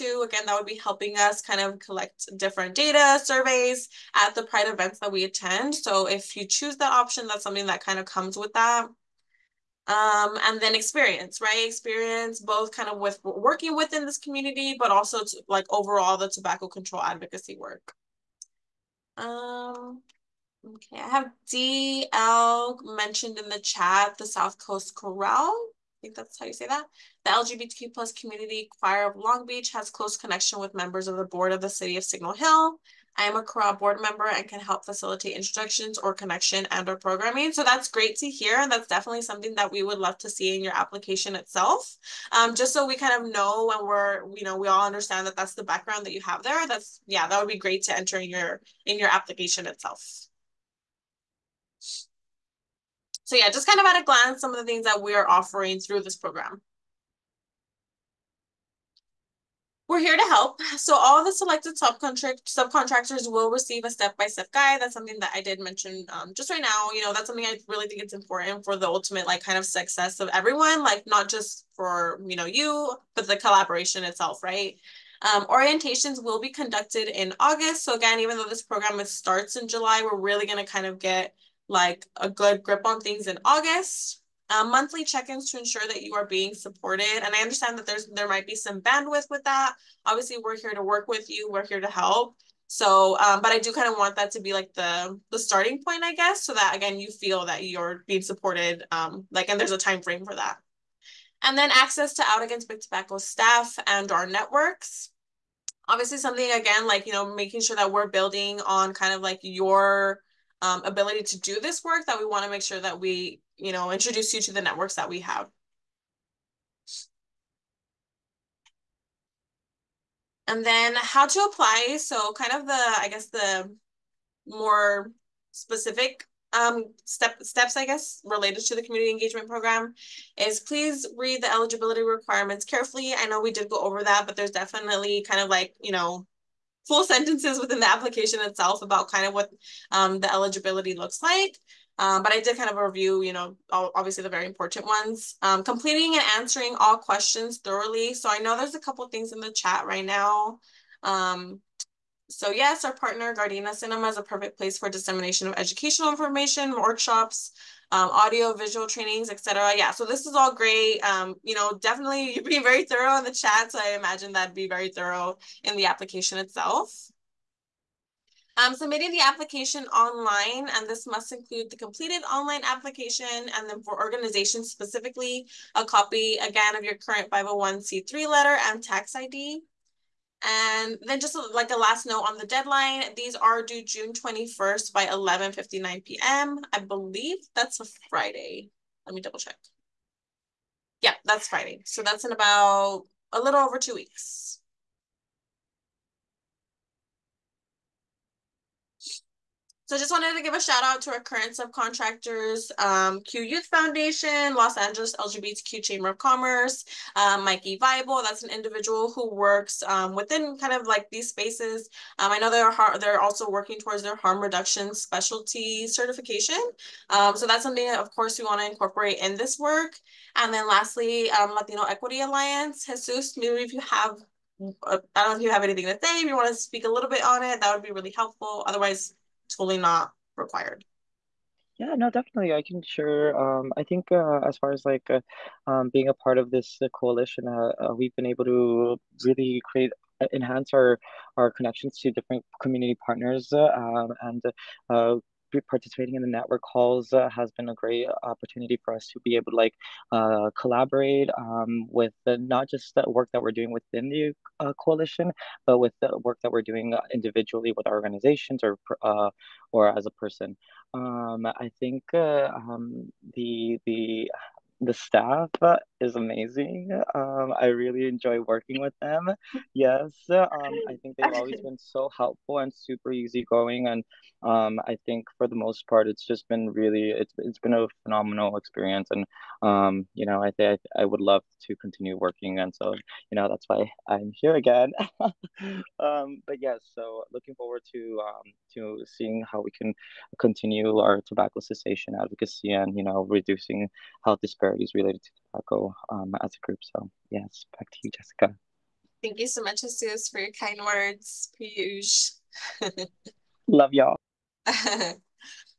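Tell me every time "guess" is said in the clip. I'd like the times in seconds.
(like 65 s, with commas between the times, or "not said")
96 s, 123 s, 127 s.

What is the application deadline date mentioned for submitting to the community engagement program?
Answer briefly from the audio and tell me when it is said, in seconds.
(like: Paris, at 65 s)
June 21, at 183 s.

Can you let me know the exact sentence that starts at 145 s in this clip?
Um, completing and answering all questions thoroughly.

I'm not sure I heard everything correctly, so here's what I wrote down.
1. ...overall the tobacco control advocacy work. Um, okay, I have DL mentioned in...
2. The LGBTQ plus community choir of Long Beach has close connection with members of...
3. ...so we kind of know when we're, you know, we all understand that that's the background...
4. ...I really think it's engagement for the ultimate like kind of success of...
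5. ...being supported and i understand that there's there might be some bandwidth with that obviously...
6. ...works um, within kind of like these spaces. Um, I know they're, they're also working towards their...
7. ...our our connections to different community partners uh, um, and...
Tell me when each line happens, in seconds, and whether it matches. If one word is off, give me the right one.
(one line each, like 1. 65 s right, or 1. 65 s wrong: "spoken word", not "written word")
1. 15 s right
2. 27 s right
3. 42 s right
4. 67 s wrong: "important", not "engagement"
5. 86 s right
6. 209 s right
7. 240 s right.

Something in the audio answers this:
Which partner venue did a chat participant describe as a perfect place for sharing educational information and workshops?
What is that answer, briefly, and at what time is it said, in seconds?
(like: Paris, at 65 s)
Gardena Cinema, at 153 s.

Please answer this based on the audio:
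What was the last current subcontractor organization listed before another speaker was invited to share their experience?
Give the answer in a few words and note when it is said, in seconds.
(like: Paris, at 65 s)
Latino Equity Alliance, at 221 s.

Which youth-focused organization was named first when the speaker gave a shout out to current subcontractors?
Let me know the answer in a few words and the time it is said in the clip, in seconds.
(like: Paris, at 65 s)
Q Youth Foundation, at 203 s.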